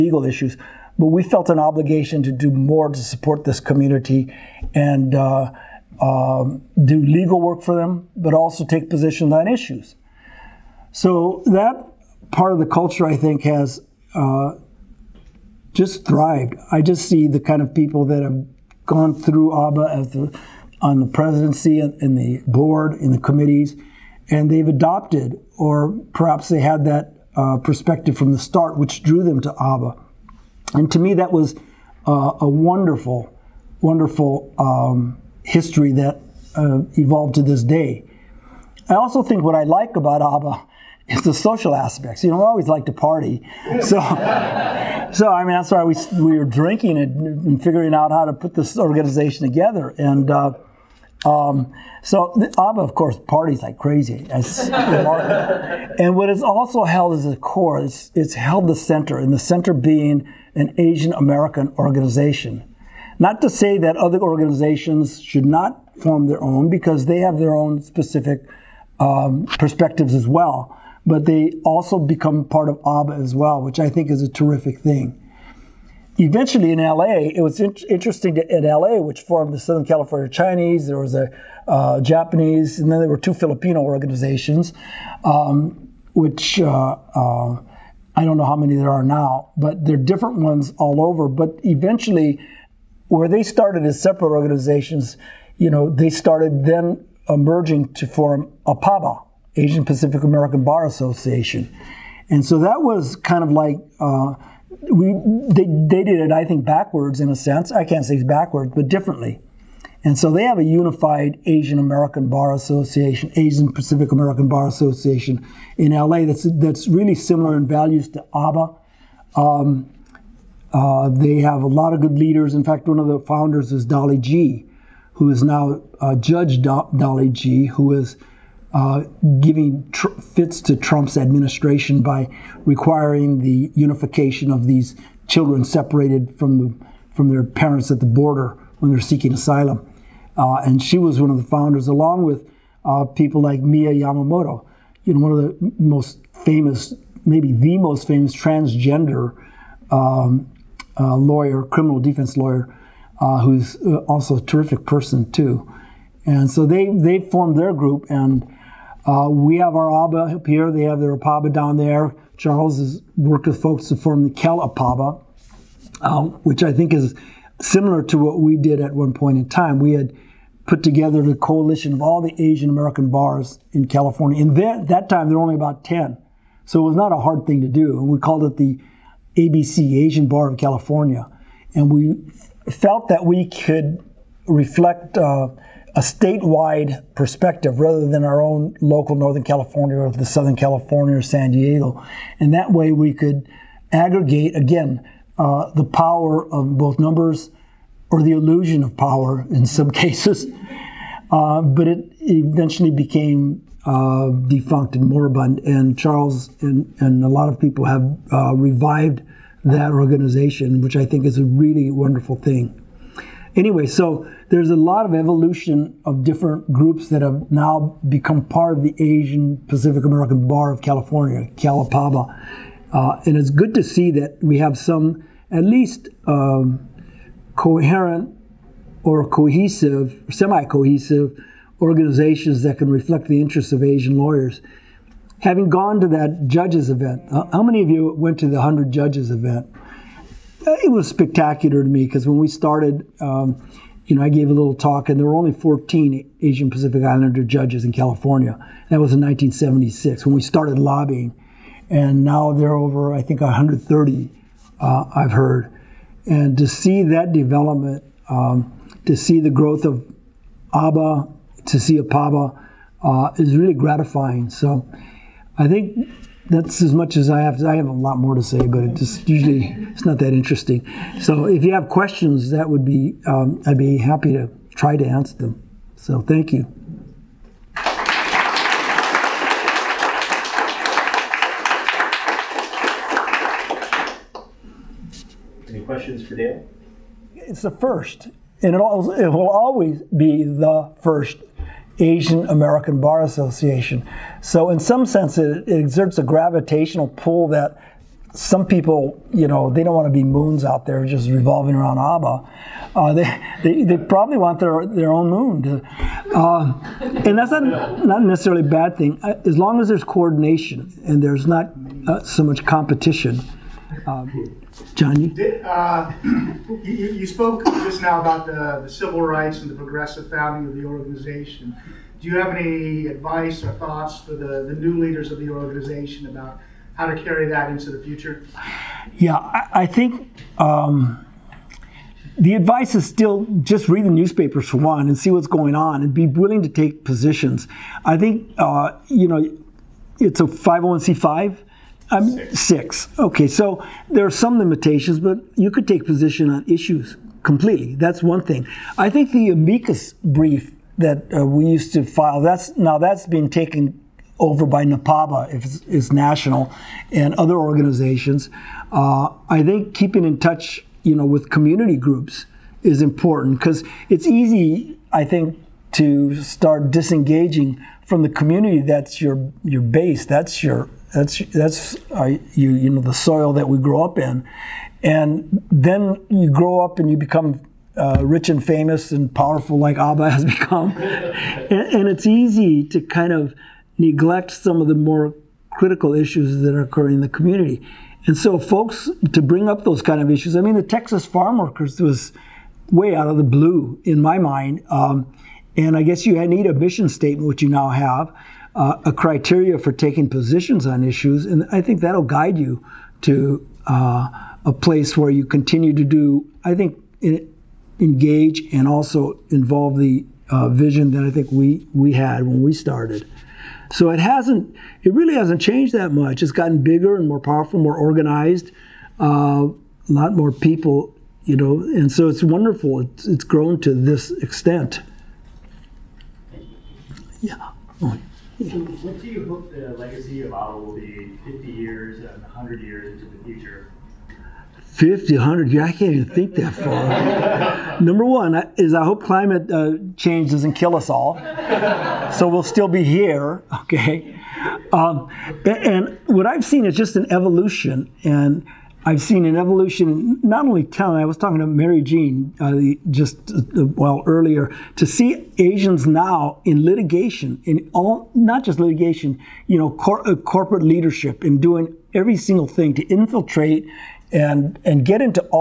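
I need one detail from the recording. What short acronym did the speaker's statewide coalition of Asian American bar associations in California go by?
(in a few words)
ABC.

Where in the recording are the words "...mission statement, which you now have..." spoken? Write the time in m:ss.
6:36.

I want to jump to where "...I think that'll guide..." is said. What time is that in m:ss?
6:41.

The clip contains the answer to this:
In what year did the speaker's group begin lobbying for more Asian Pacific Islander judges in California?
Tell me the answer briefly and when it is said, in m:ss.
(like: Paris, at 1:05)
1976, at 4:09.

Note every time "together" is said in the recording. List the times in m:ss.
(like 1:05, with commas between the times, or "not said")
0:49, 2:50.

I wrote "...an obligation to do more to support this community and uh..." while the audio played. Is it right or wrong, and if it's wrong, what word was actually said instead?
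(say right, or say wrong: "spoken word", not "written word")
right.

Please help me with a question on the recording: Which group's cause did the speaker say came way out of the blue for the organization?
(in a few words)
Texas farm workers.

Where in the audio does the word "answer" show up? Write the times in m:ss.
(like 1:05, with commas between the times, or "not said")
4:35.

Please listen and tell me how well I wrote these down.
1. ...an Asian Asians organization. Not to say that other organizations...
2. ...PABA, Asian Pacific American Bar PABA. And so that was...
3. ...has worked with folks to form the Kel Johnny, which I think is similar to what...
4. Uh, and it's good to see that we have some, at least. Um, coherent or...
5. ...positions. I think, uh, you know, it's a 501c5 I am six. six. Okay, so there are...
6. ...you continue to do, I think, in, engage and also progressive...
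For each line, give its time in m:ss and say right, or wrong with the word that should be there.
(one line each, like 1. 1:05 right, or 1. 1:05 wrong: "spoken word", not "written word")
1. 1:00 wrong: "American", not "Asians"
2. 1:38 wrong: "Association", not "PABA"
3. 2:42 wrong: "APABA", not "Johnny"
4. 3:42 right
5. 5:37 right
6. 6:45 wrong: "involve", not "progressive".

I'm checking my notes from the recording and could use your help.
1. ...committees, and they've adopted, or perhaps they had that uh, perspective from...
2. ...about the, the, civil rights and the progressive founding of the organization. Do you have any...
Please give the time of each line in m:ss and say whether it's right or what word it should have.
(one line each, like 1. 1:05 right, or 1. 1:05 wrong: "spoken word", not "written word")
1. 0:23 right
2. 5:18 right.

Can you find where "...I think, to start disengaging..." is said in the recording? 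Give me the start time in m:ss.
6:05.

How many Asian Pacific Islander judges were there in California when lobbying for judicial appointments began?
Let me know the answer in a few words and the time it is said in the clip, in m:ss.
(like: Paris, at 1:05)
14, at 4:05.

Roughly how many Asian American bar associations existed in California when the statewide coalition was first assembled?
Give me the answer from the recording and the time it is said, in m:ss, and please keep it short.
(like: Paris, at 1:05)
10, at 2:55.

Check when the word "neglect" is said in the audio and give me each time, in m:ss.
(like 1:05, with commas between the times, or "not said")
6:23.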